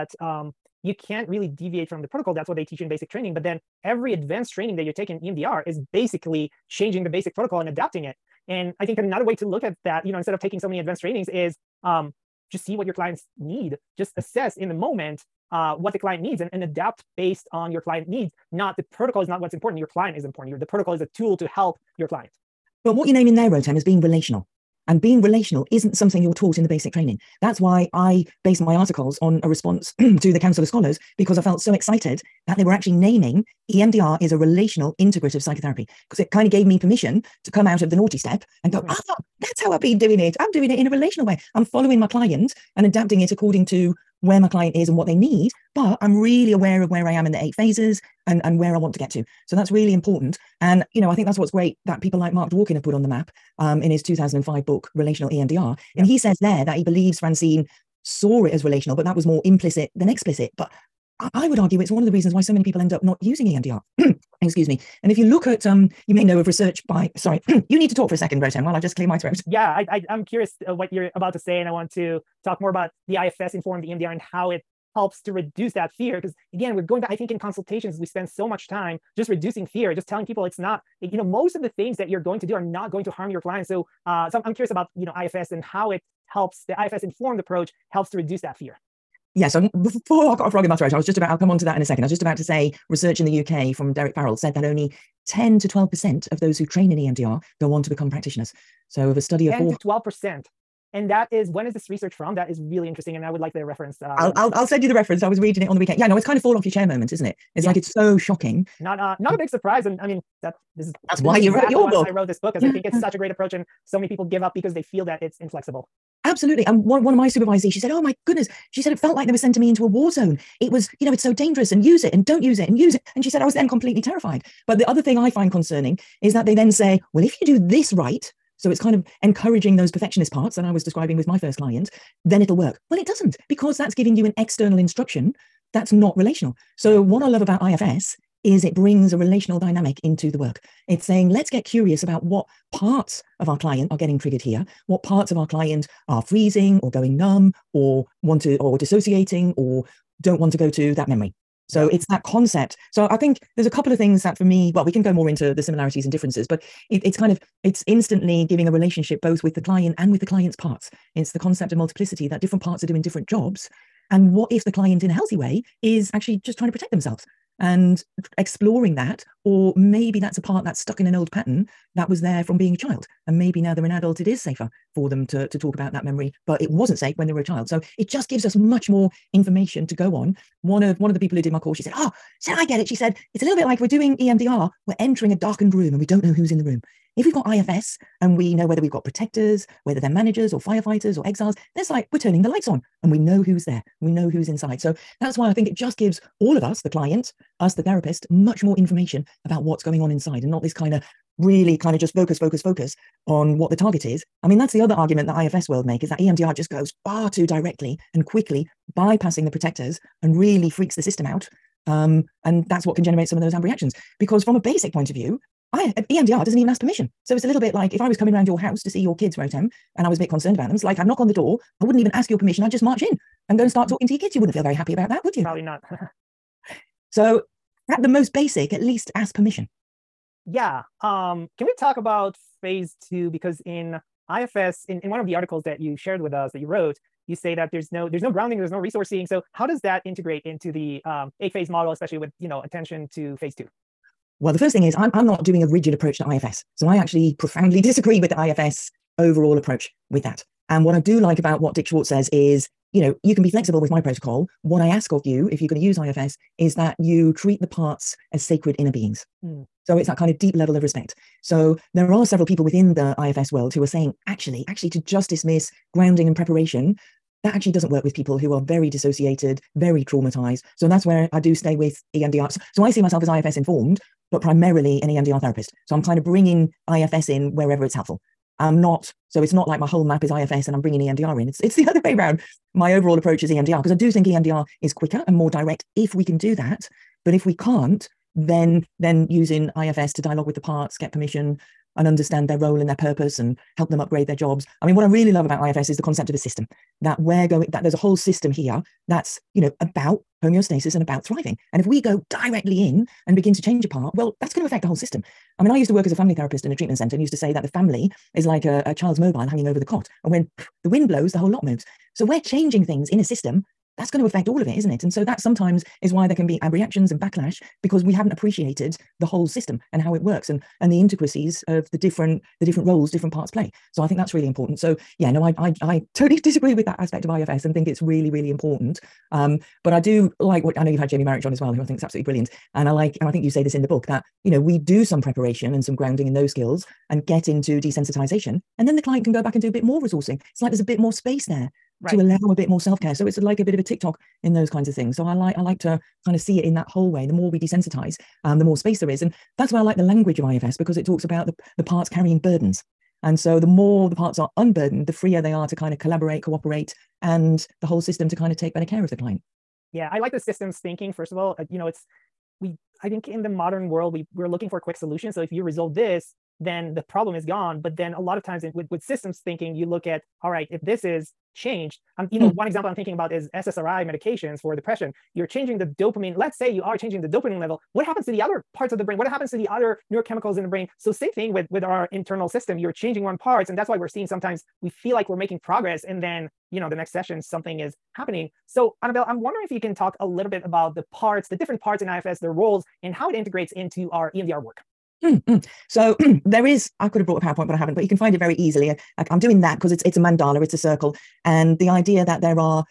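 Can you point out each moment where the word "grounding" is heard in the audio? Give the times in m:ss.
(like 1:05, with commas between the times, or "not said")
3:58, 4:25, 5:35.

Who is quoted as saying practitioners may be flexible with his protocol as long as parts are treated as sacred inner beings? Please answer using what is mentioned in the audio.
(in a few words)
Dick Schwartz.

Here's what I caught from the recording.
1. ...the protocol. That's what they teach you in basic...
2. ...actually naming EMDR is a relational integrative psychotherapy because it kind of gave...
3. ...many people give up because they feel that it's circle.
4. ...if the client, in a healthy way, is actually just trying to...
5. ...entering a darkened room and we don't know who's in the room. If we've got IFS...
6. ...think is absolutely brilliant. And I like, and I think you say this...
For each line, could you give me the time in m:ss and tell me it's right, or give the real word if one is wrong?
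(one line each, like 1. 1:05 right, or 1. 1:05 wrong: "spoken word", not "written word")
1. 0:02 right
2. 0:32 right
3. 1:53 wrong: "inflexible", not "circle"
4. 2:44 right
5. 3:04 right
6. 5:31 right.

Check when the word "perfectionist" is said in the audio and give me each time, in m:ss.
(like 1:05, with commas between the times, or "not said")
2:09.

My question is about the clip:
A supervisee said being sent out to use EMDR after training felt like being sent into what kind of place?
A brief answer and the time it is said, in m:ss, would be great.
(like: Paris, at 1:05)
a war zone, at 1:59.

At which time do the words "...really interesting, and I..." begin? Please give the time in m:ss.
1:42.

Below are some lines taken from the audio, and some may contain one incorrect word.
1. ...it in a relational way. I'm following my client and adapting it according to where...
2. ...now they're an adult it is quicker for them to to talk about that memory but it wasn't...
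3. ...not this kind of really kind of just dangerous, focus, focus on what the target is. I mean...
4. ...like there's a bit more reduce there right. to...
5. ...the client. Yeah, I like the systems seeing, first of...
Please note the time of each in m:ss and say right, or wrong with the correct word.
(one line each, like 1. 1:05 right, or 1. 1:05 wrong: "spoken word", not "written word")
1. 0:40 right
2. 2:53 wrong: "safer", not "quicker"
3. 3:20 wrong: "focus", not "dangerous"
4. 5:40 wrong: "space", not "reduce"
5. 5:59 wrong: "thinking", not "seeing".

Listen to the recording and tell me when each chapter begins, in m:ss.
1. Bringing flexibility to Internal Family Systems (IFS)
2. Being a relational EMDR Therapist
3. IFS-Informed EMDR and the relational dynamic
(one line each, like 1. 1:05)
1. 4:07
2. 0:27
3. 2:19.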